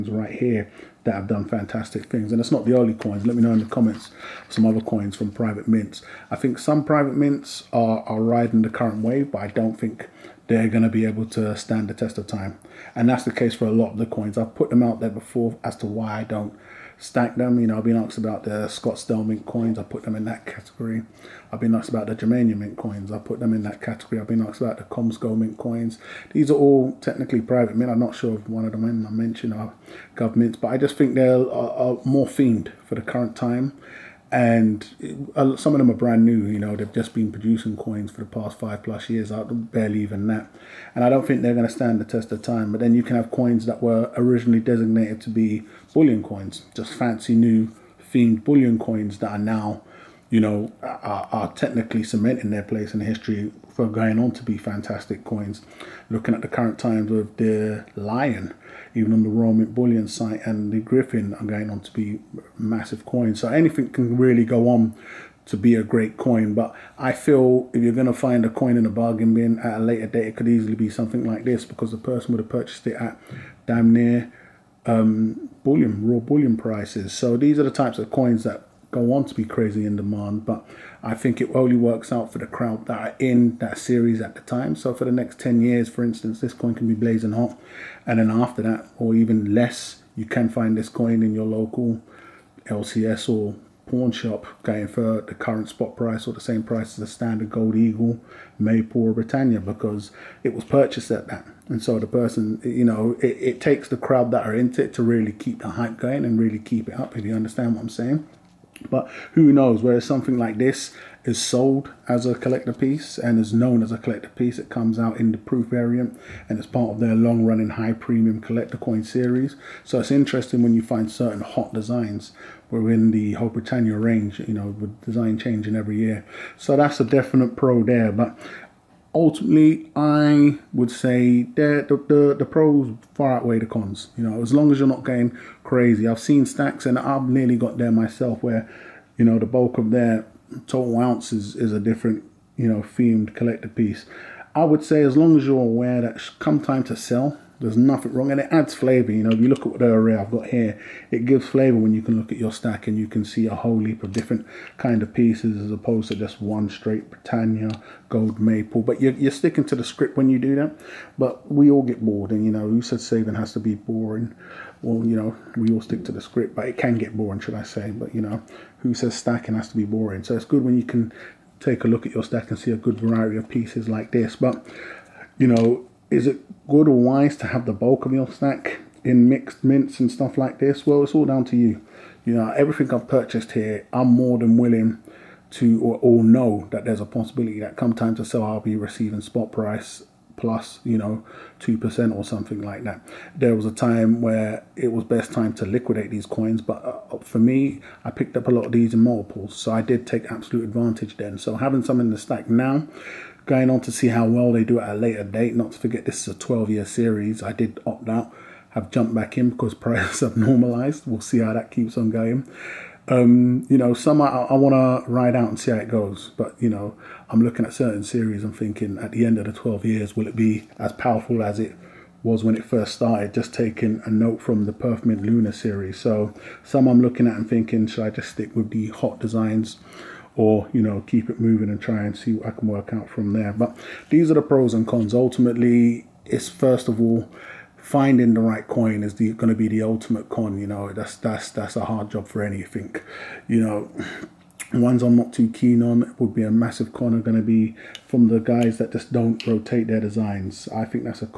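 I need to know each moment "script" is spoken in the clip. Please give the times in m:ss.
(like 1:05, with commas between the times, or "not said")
2:39, 2:46.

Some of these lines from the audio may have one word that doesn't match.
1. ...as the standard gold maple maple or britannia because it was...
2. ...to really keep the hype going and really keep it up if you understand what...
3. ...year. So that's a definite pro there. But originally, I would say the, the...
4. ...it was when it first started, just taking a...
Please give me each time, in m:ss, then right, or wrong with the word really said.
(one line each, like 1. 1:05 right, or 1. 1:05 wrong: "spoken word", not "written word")
1. 1:36 wrong: "eagle", not "maple"
2. 1:44 right
3. 2:05 wrong: "ultimately", not "originally"
4. 3:41 right.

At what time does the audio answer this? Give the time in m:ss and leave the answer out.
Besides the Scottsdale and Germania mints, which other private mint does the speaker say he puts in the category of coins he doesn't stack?
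0:24.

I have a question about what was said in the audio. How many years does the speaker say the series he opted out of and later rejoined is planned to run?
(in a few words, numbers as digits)
12.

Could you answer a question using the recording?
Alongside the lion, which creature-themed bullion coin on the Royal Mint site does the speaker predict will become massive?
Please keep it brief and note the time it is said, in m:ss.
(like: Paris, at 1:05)
griffin, at 1:00.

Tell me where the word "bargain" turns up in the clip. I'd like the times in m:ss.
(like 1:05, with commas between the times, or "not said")
1:08.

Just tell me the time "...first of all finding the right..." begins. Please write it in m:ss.
3:56.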